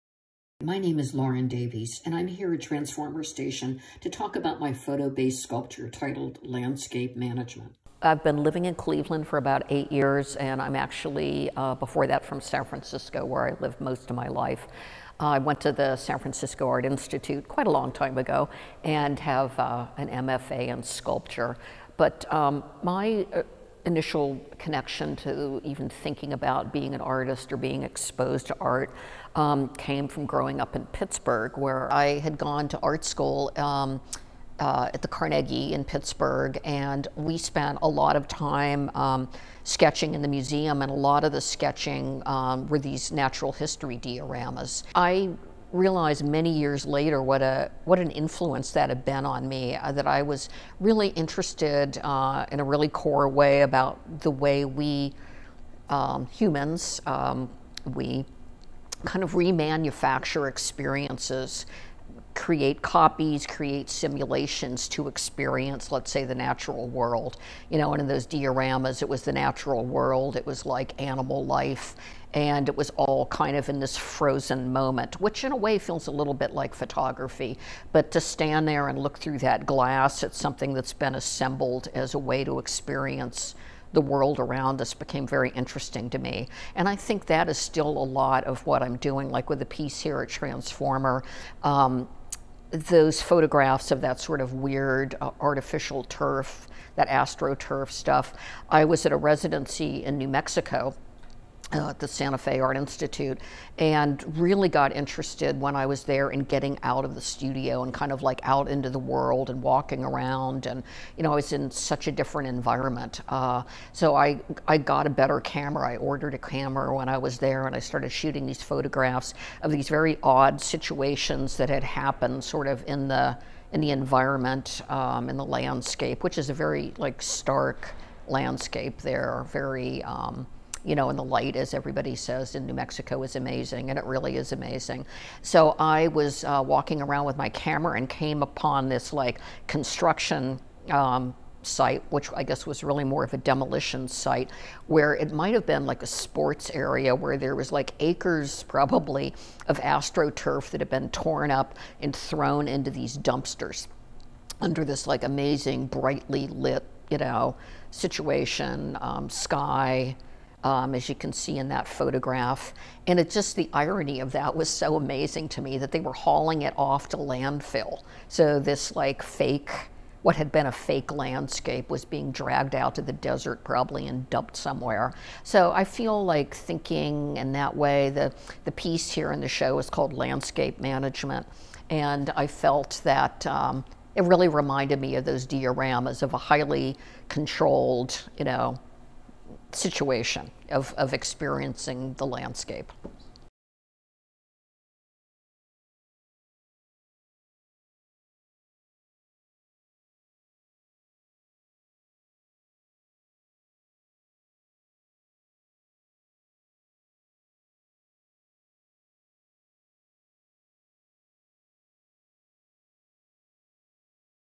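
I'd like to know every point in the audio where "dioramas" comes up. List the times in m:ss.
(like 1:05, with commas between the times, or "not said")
0:43, 1:08, 3:05.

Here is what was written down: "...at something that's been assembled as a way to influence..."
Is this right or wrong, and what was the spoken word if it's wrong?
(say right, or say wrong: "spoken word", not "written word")
wrong: "experience", not "influence".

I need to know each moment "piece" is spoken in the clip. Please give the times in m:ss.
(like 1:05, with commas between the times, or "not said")
1:29, 2:58.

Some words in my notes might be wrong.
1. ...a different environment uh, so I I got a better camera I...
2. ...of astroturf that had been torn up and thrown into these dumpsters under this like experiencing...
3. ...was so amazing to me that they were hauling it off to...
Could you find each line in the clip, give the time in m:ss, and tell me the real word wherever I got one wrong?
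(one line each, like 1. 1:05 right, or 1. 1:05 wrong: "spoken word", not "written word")
1. 1:52 right
2. 2:29 wrong: "amazing", not "experiencing"
3. 2:44 right.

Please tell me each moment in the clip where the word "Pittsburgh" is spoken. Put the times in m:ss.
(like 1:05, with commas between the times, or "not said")
0:30, 0:35.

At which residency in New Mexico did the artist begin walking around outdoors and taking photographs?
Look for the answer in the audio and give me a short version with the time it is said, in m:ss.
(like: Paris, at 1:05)
Santa Fe Art Institute, at 1:42.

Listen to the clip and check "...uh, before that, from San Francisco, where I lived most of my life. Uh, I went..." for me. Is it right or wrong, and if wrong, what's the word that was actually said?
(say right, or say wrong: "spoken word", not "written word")
right.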